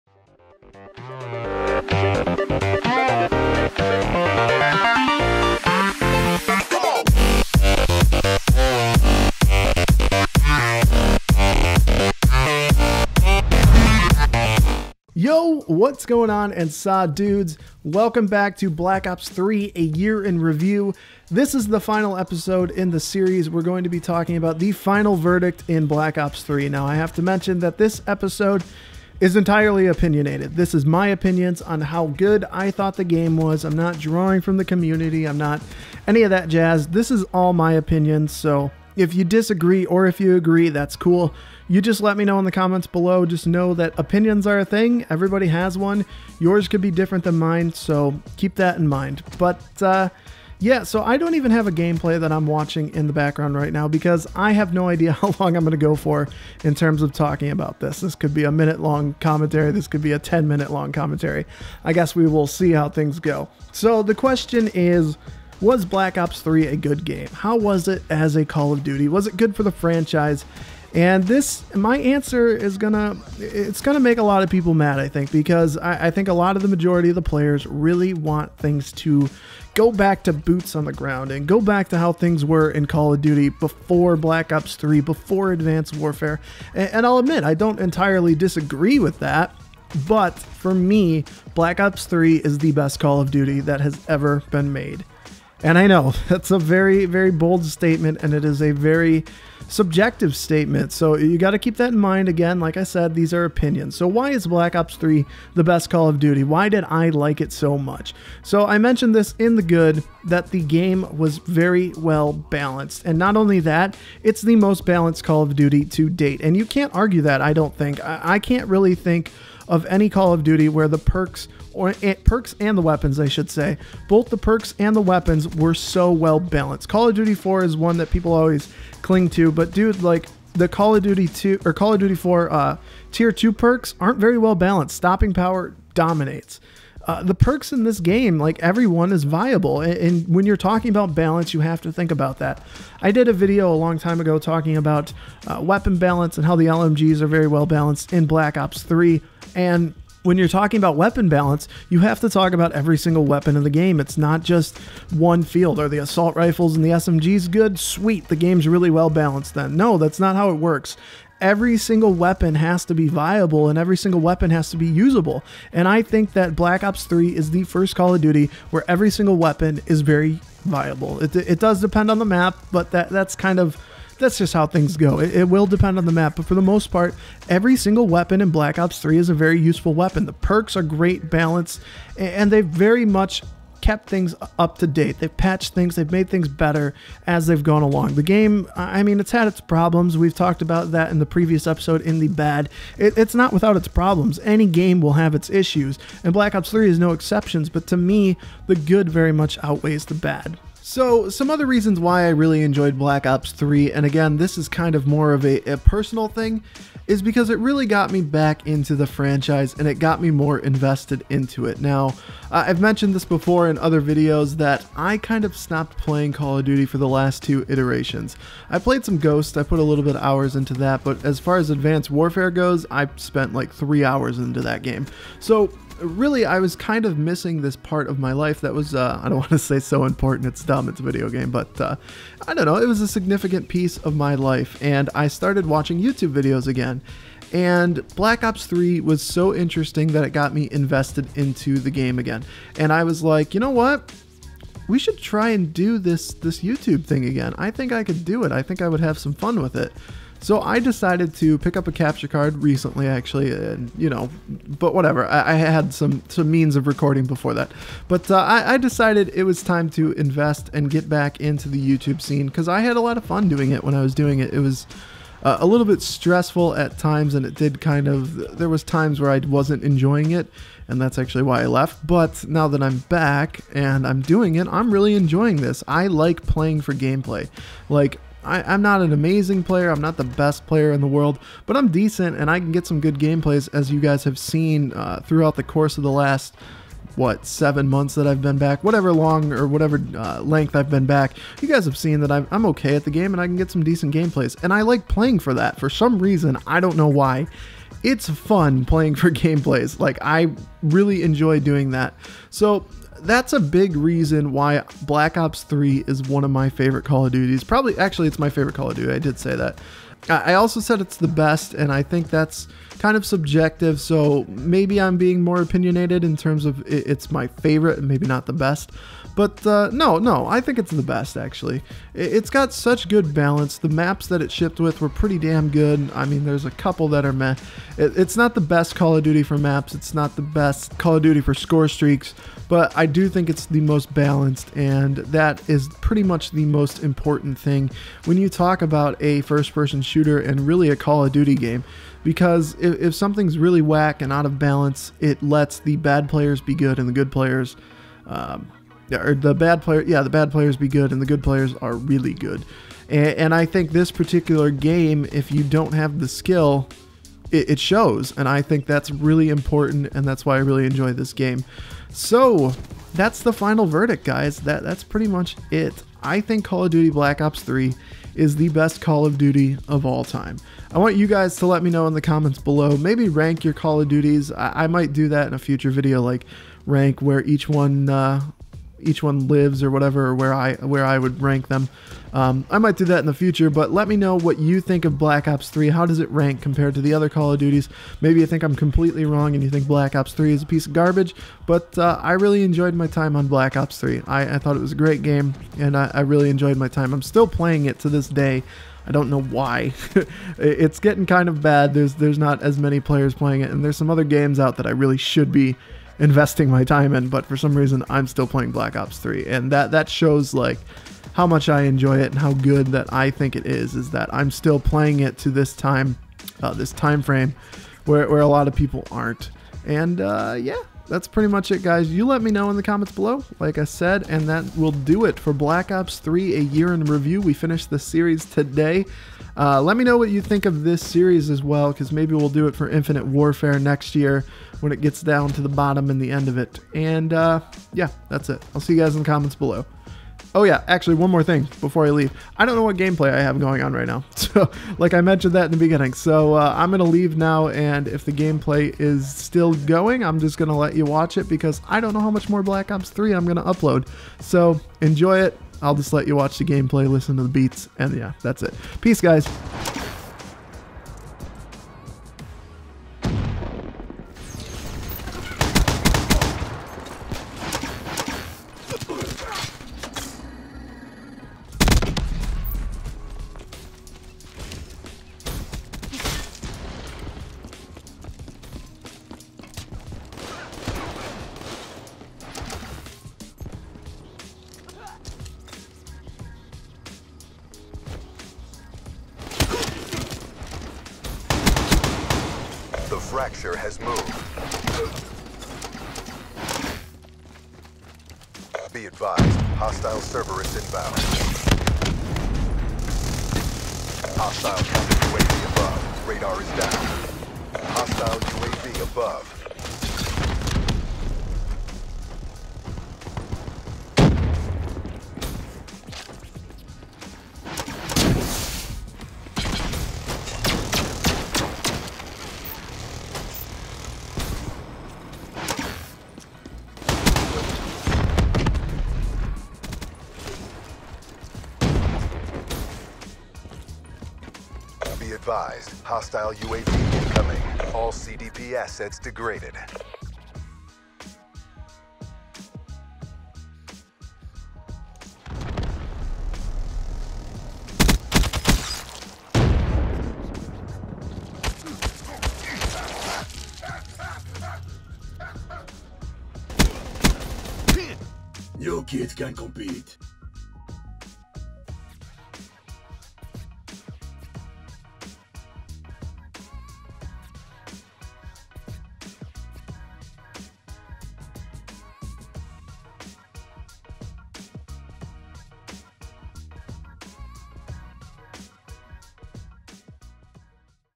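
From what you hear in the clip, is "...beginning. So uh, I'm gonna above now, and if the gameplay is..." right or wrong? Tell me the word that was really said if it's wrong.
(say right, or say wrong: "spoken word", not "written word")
wrong: "leave", not "above".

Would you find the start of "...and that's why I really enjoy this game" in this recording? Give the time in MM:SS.
06:00.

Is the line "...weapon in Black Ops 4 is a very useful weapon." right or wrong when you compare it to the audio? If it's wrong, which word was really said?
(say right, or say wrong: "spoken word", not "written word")
wrong: "3", not "4".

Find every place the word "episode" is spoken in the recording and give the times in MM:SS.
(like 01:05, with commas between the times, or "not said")
00:22, 00:28, 03:11.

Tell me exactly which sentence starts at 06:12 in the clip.
Maybe rank your Call of Duties.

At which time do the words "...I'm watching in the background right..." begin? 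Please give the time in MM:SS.
00:52.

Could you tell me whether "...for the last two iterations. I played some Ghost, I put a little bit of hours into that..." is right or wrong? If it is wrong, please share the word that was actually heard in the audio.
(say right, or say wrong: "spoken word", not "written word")
right.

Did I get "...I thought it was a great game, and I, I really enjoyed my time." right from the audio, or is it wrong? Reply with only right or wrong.
right.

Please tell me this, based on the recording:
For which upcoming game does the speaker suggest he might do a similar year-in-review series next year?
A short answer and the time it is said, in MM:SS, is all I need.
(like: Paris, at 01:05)
Infinite Warfare, at 07:12.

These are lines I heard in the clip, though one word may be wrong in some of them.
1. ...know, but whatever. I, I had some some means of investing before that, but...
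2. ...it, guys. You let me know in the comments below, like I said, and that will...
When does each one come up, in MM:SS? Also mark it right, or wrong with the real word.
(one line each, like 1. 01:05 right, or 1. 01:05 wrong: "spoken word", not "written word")
1. 04:14 wrong: "recording", not "investing"
2. 07:01 right.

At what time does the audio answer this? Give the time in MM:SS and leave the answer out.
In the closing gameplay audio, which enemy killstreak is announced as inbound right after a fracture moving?
08:20.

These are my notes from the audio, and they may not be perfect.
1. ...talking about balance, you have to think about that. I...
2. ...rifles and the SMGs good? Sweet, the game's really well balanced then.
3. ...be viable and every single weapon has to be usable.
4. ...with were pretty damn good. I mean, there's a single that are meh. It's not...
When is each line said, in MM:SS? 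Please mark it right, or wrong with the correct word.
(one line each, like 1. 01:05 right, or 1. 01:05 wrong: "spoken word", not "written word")
1. 02:20 right
2. 02:36 right
3. 02:42 right
4. 05:24 wrong: "couple", not "single".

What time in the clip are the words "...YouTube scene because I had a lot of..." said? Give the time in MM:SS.
04:21.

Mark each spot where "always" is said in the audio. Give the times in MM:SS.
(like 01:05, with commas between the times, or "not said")
02:08.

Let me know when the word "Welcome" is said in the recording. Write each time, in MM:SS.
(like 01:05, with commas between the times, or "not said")
00:17.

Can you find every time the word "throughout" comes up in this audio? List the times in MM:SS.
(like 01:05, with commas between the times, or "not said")
04:45.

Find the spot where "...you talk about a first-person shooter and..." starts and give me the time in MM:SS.
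05:38.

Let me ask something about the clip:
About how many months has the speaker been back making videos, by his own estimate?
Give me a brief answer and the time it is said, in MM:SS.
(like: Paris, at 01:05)
7, at 04:47.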